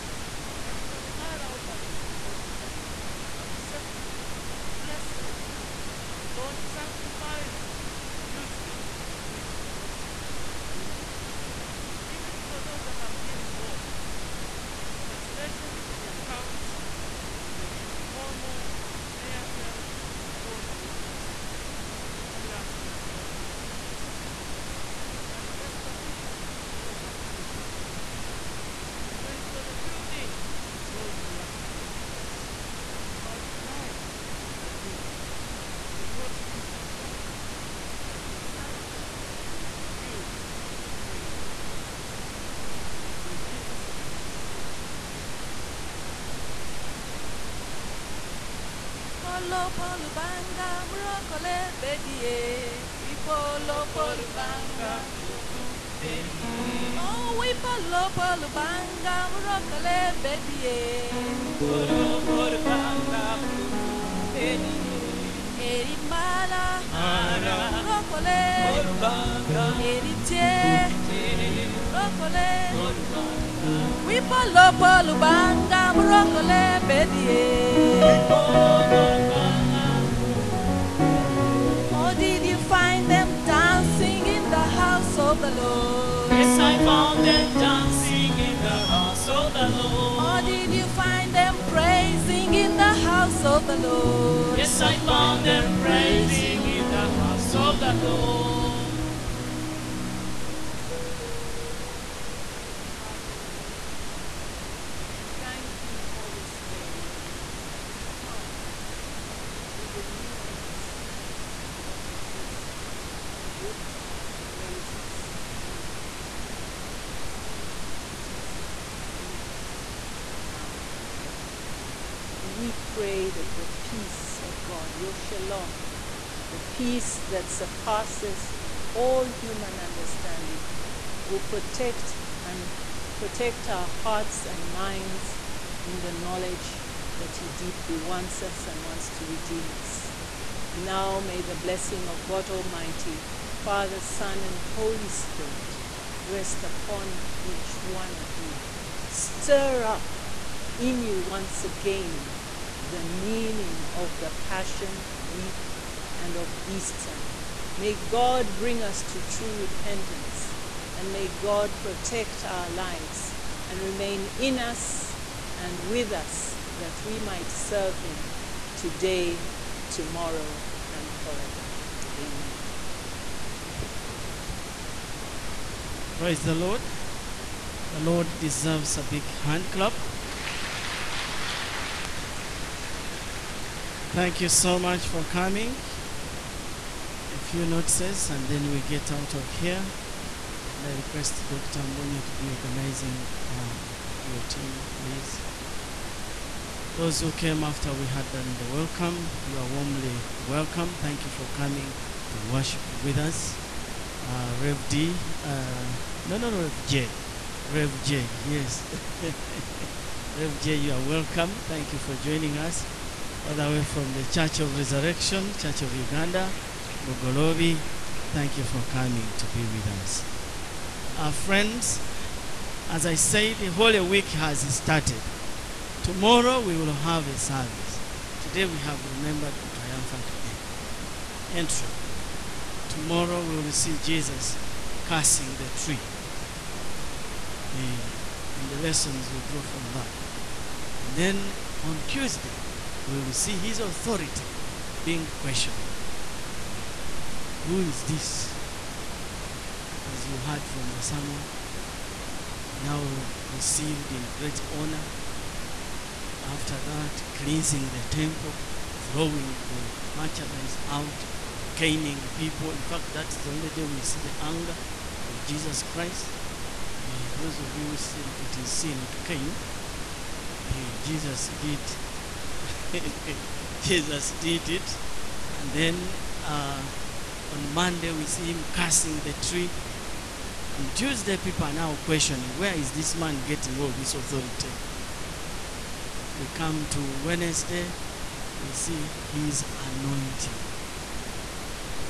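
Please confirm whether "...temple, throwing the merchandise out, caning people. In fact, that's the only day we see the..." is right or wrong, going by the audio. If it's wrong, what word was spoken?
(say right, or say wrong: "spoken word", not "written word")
right.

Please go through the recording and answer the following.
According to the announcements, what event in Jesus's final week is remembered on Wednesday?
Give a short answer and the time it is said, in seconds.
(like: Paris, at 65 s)
his anointing, at 289 s.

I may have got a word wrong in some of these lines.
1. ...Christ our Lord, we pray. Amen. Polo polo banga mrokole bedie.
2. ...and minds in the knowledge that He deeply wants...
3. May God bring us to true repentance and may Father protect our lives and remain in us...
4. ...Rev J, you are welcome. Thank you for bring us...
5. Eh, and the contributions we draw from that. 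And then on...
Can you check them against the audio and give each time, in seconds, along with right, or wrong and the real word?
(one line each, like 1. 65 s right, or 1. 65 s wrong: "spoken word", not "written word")
1. 43 s right
2. 134 s right
3. 157 s wrong: "God", not "Father"
4. 210 s wrong: "joining", not "bring"
5. 237 s wrong: "lessons", not "contributions".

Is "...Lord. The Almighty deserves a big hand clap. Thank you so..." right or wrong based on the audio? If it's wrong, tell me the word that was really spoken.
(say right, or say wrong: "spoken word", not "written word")
wrong: "Lord", not "Almighty".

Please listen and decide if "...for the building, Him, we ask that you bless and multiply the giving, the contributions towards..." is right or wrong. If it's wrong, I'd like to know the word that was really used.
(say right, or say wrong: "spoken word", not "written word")
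wrong: "Lord", not "Him".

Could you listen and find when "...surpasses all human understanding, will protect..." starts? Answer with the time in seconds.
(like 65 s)
127 s.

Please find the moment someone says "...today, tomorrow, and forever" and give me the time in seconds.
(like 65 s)
168 s.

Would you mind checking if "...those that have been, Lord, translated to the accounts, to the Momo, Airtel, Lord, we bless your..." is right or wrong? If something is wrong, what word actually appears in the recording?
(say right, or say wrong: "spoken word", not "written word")
right.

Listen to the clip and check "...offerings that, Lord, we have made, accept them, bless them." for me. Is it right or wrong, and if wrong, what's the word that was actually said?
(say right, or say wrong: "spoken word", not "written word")
right.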